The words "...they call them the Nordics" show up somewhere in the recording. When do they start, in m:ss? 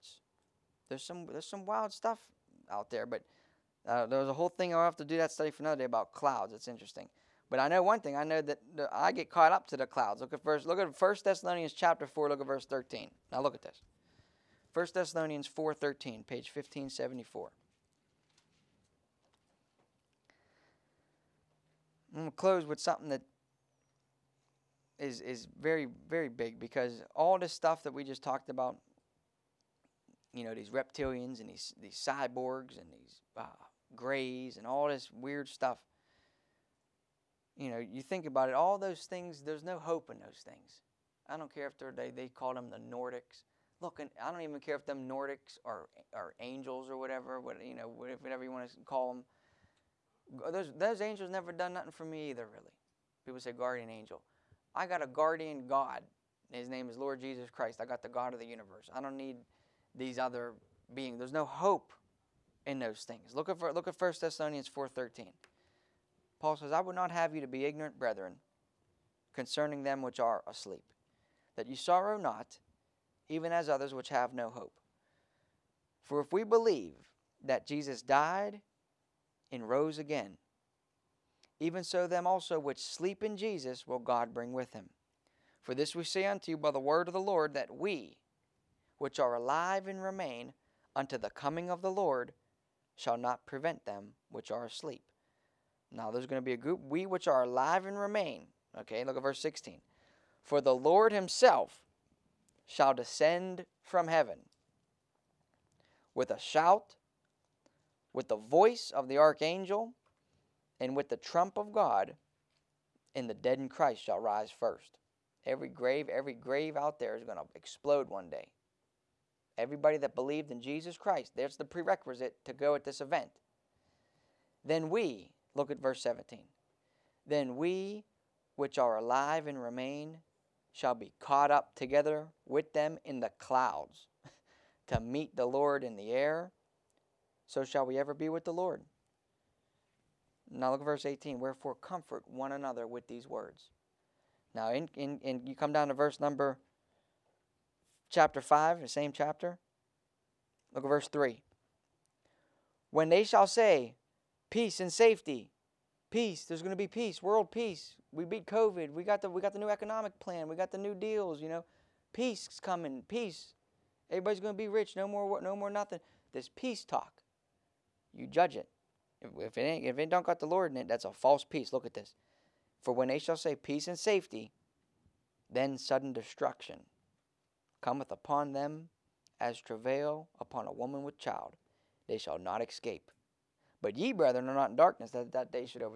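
0:42.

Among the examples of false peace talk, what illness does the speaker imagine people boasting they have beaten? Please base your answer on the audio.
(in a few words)
COVID.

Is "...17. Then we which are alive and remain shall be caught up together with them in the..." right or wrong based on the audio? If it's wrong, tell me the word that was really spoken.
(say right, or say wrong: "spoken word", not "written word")
right.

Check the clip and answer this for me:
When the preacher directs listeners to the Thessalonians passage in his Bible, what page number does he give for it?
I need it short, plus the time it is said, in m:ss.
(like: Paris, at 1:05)
1574, at 0:16.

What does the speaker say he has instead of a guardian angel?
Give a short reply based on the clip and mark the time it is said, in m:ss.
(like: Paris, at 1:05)
guardian God, at 0:55.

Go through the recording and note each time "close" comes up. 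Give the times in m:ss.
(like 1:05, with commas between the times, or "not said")
0:22.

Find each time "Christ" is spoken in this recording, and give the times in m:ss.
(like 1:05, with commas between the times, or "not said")
0:57, 1:53, 2:00.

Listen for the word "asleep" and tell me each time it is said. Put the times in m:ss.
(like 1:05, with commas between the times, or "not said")
1:10, 1:34.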